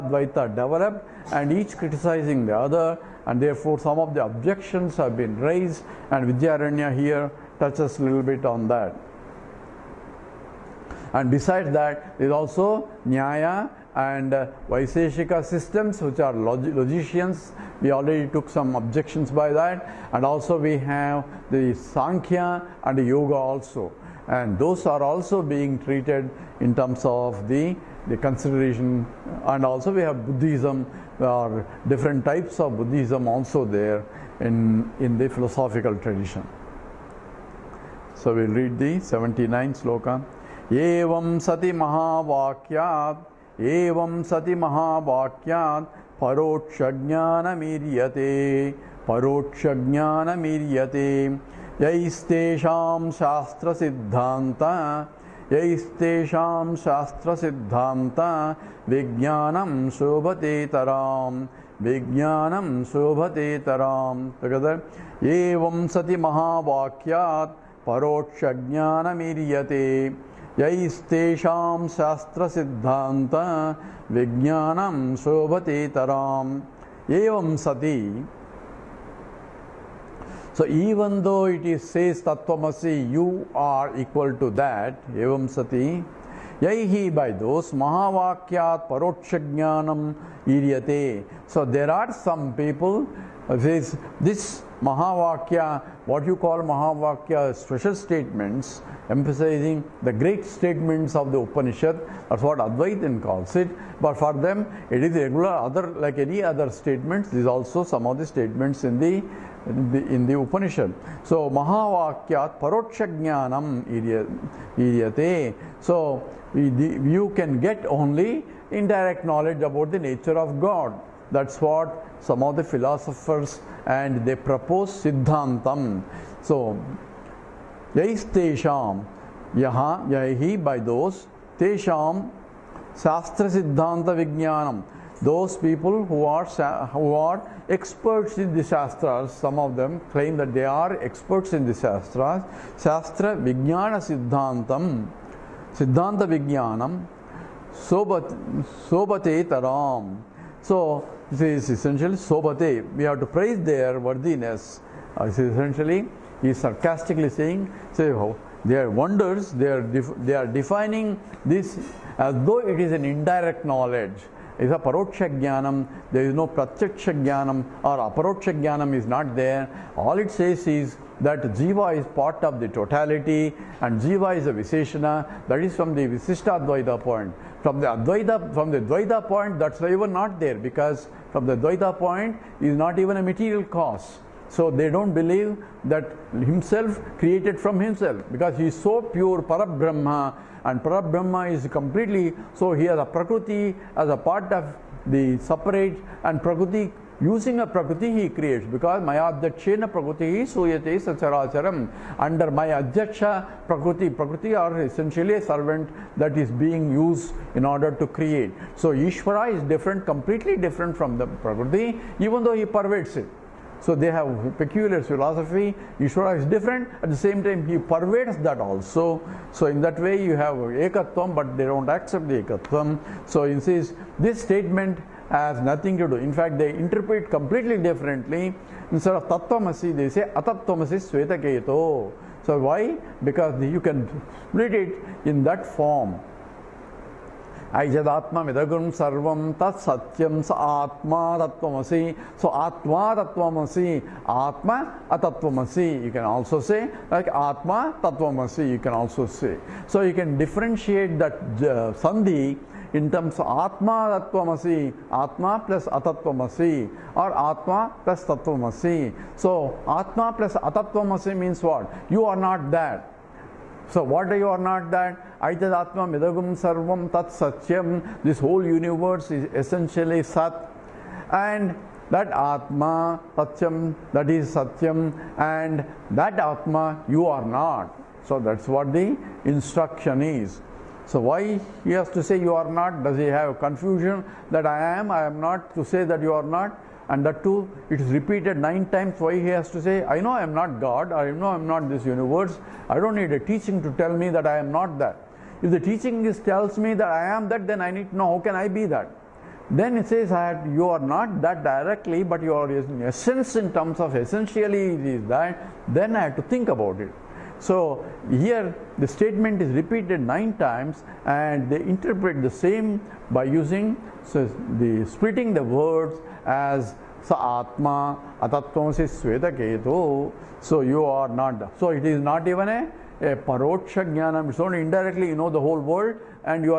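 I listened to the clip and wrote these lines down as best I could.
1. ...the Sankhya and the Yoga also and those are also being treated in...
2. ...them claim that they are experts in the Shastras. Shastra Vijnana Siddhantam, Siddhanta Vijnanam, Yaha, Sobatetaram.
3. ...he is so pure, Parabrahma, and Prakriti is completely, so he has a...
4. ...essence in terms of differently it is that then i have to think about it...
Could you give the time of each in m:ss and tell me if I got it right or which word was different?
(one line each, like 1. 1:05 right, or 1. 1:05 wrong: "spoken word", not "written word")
1. 0:21 right
2. 2:19 wrong: "Sobat", not "Yaha"
3. 3:08 wrong: "Brahma", not "Prakriti"
4. 5:03 wrong: "essentially", not "differently".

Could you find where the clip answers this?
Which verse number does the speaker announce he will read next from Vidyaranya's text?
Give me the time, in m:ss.
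0:39.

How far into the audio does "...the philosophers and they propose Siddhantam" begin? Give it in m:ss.
2:02.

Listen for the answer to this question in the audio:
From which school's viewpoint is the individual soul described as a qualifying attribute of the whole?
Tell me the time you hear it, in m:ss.
2:56.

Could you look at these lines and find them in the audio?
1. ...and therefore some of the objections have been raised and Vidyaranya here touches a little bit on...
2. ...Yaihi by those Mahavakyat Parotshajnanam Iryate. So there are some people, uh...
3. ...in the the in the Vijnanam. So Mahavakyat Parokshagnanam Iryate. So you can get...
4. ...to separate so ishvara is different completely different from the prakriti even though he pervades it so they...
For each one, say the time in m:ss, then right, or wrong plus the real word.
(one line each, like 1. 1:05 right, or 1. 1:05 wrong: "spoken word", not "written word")
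1. 0:03 right
2. 1:26 right
3. 1:48 wrong: "Upanishad", not "Vijnanam"
4. 3:27 wrong: "create", not "separate".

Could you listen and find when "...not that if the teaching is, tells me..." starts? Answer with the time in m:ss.
4:54.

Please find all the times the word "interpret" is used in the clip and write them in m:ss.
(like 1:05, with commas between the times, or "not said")
3:46, 5:11.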